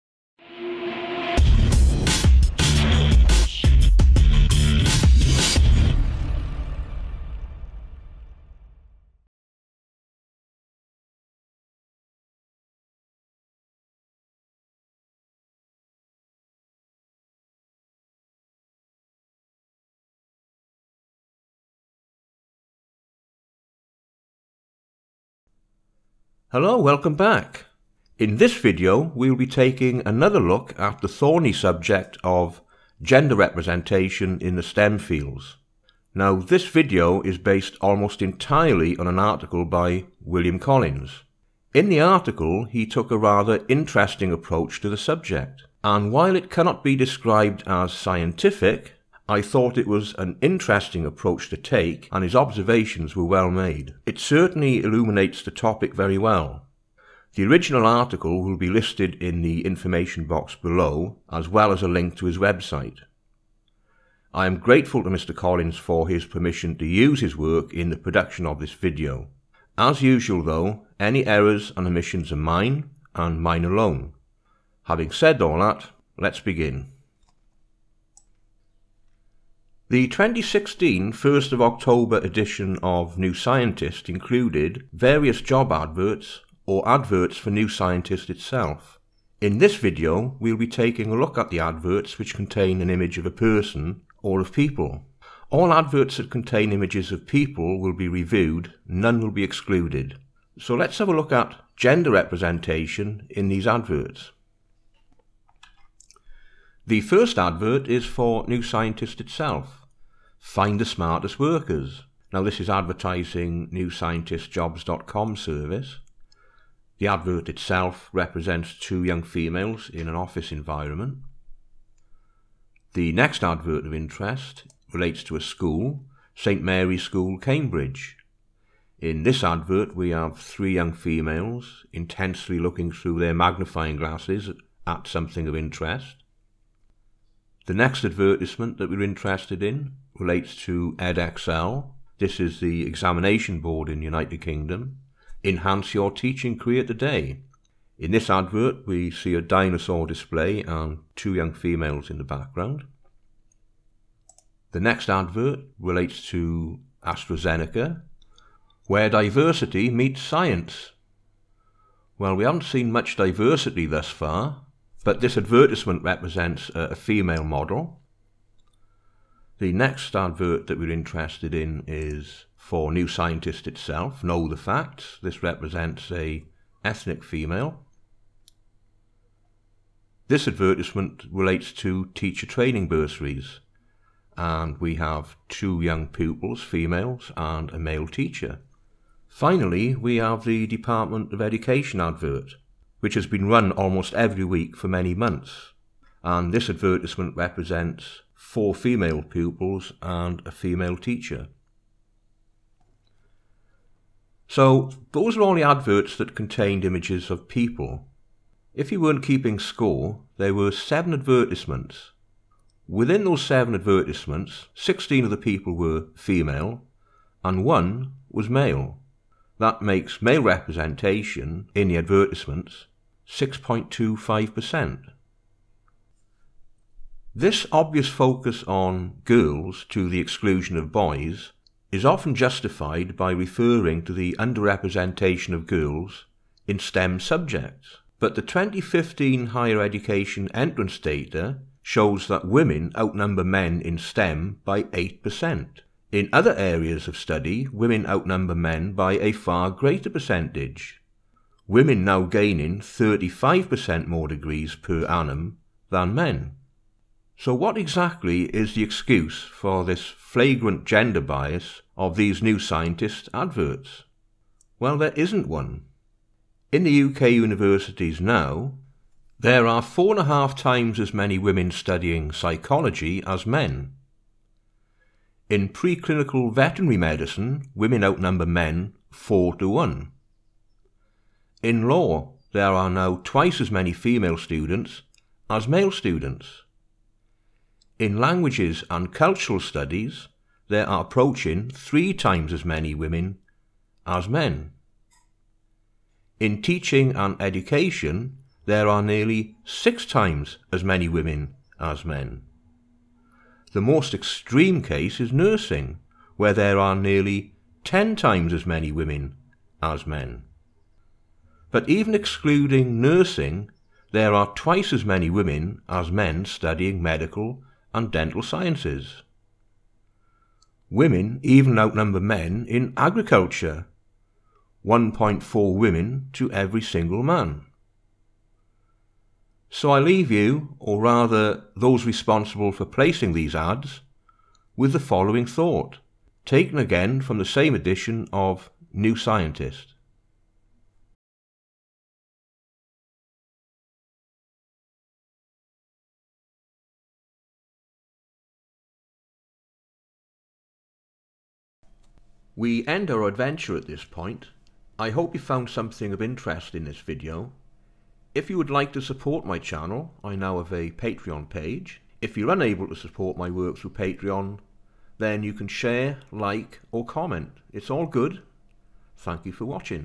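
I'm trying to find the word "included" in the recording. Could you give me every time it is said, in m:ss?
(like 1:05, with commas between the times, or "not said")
1:24.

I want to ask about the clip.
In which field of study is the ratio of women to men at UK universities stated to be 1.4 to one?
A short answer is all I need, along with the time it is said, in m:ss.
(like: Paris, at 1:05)
Agriculture, at 5:22.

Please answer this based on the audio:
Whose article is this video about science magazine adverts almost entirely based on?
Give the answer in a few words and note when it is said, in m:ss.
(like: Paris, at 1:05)
William Collins, at 0:40.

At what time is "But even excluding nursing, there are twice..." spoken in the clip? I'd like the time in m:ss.
5:11.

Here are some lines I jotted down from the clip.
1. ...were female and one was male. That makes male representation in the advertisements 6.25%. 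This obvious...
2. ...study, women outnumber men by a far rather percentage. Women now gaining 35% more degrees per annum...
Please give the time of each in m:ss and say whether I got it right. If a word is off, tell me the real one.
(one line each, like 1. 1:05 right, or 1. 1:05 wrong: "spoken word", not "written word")
1. 3:35 right
2. 4:07 wrong: "greater", not "rather".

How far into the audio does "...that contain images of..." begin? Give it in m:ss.
1:36.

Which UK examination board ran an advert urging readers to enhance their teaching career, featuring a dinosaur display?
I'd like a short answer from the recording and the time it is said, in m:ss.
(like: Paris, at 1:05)
Edexcel, at 2:20.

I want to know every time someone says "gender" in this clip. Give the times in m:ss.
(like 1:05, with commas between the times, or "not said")
0:33, 1:41, 4:20.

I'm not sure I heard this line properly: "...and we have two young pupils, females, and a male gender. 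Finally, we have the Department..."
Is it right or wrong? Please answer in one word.
wrong.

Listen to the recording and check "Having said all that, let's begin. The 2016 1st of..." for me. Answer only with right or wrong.
right.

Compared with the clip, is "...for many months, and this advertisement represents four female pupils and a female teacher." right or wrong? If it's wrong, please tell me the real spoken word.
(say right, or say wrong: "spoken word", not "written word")
right.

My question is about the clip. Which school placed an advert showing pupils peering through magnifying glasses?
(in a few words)
St Mary's School, Cambridge.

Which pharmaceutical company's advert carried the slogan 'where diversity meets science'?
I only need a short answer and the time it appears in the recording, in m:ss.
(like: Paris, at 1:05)
AstraZeneca, at 2:37.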